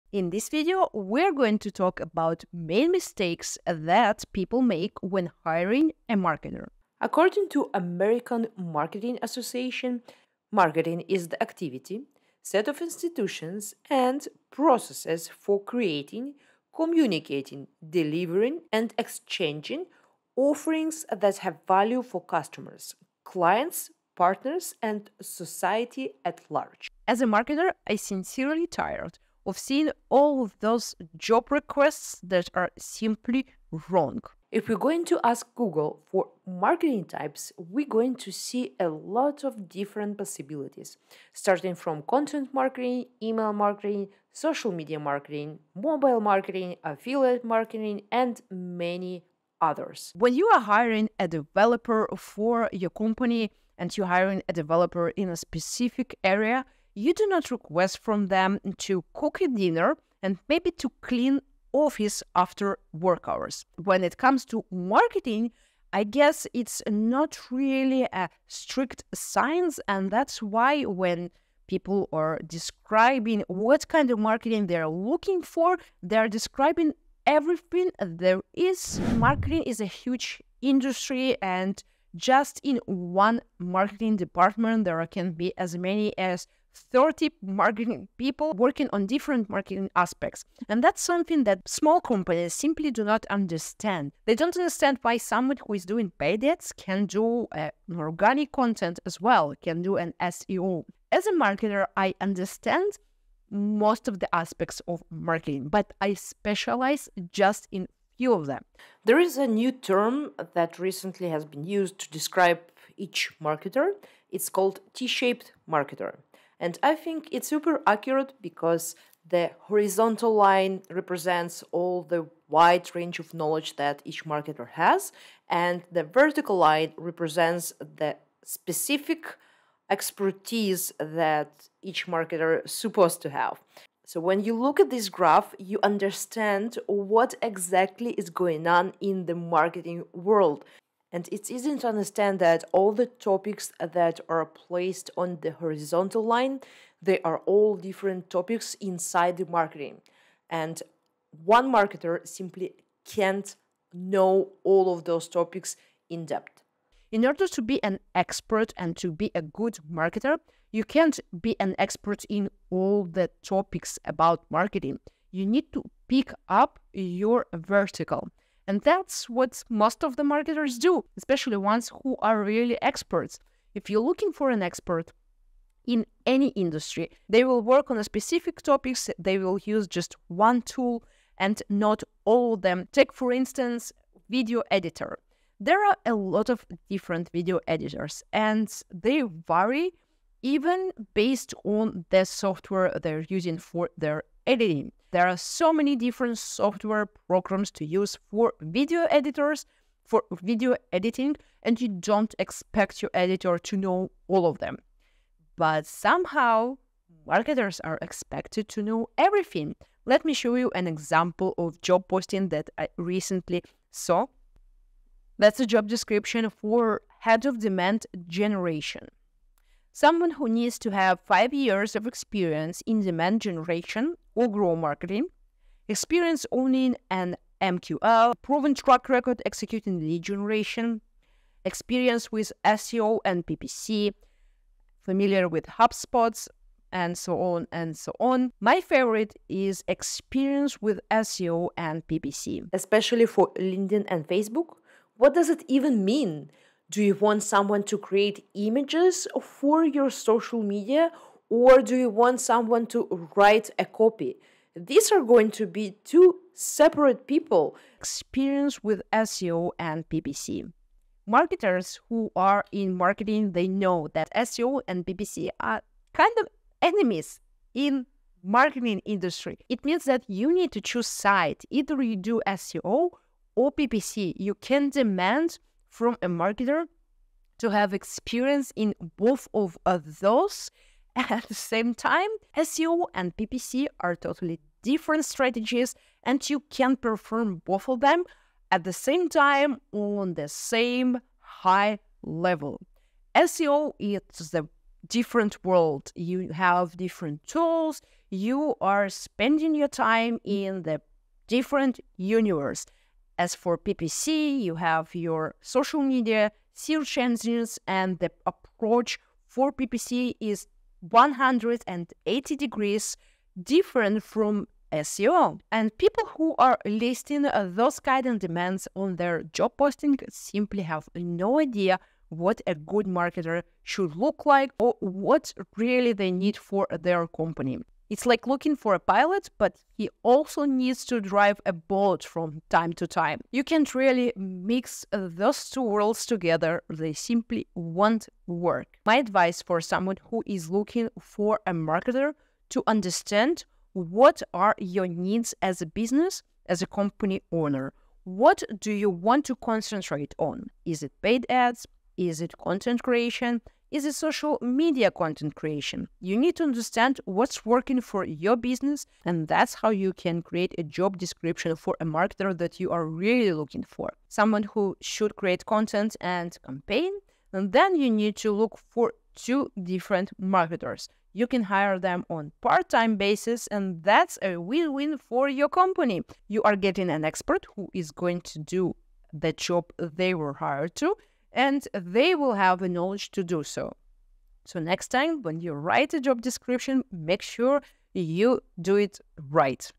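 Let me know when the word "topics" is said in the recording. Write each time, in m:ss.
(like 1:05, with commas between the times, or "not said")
2:23, 2:28, 2:35, 2:43, 2:58.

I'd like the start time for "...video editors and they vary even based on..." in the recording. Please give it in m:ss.
3:07.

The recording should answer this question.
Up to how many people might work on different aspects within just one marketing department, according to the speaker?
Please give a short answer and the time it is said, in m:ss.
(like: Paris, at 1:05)
30, at 1:26.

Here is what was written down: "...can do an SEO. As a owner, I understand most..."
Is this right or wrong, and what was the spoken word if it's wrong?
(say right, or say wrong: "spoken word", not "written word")
wrong: "marketer", not "owner".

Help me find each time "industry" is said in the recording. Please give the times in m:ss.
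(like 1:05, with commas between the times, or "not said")
1:20, 2:56, 4:29.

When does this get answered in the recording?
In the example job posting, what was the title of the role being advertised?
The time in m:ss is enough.
3:37.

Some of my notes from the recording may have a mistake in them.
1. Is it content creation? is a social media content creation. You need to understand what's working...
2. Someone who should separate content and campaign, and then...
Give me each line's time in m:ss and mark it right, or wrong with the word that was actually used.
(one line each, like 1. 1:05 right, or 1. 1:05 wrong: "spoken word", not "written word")
1. 5:52 right
2. 6:04 wrong: "create", not "separate".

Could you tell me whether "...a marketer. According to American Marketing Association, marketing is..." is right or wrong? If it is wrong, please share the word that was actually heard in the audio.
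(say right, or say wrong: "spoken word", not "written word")
right.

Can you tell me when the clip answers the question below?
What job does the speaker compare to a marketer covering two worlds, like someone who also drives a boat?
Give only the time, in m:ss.
5:28.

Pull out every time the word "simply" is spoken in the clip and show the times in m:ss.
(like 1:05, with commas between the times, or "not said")
0:32, 1:32, 2:32, 5:20, 5:37.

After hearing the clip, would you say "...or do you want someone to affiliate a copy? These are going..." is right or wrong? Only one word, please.
wrong.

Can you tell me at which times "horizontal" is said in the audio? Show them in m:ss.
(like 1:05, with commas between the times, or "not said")
1:59, 2:25.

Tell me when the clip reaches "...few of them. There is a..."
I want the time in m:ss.
1:48.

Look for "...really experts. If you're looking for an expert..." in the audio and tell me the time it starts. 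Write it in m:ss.
2:52.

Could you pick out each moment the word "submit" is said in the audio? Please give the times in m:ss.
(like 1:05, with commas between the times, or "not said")
not said.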